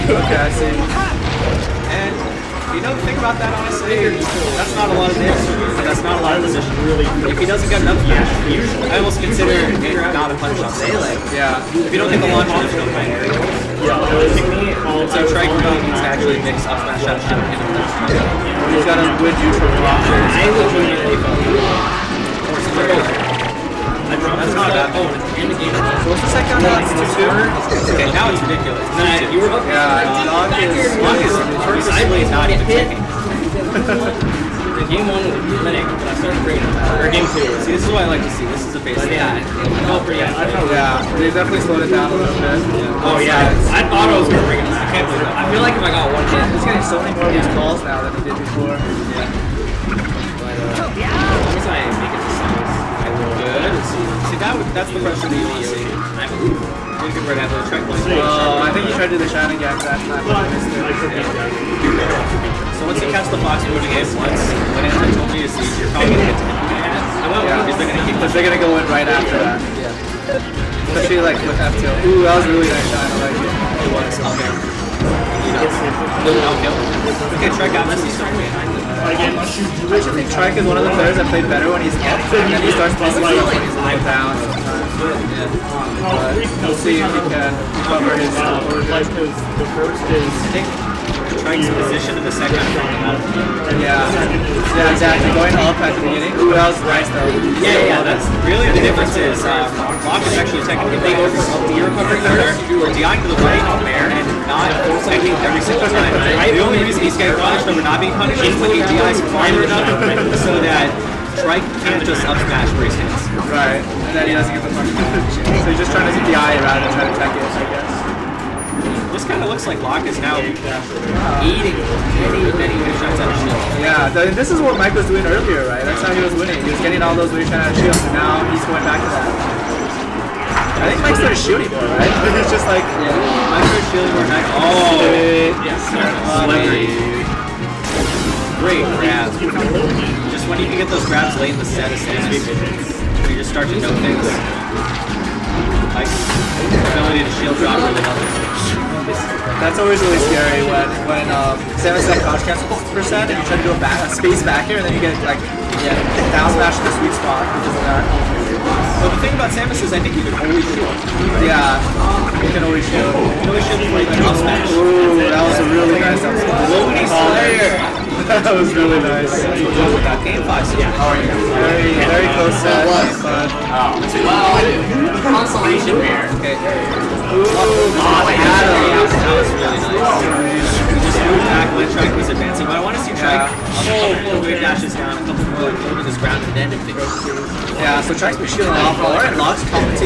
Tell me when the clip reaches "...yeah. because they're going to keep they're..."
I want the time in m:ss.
1:07.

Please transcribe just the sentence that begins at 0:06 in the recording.
Really, if he doesn't get enough damage, I almost consider it not a punch on Yeah.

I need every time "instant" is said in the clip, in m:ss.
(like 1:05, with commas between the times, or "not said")
not said.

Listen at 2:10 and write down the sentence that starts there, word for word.
I think Mike started shooting more, right?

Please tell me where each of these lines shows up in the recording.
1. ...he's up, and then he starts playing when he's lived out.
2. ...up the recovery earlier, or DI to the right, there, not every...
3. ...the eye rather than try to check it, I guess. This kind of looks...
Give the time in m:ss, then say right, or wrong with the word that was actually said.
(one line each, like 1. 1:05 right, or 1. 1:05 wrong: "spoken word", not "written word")
1. 1:21 right
2. 1:41 wrong: "corner", not "earlier"
3. 1:56 right.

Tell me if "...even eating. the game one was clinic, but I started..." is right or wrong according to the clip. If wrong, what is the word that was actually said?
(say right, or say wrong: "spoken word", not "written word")
wrong: "checking", not "eating".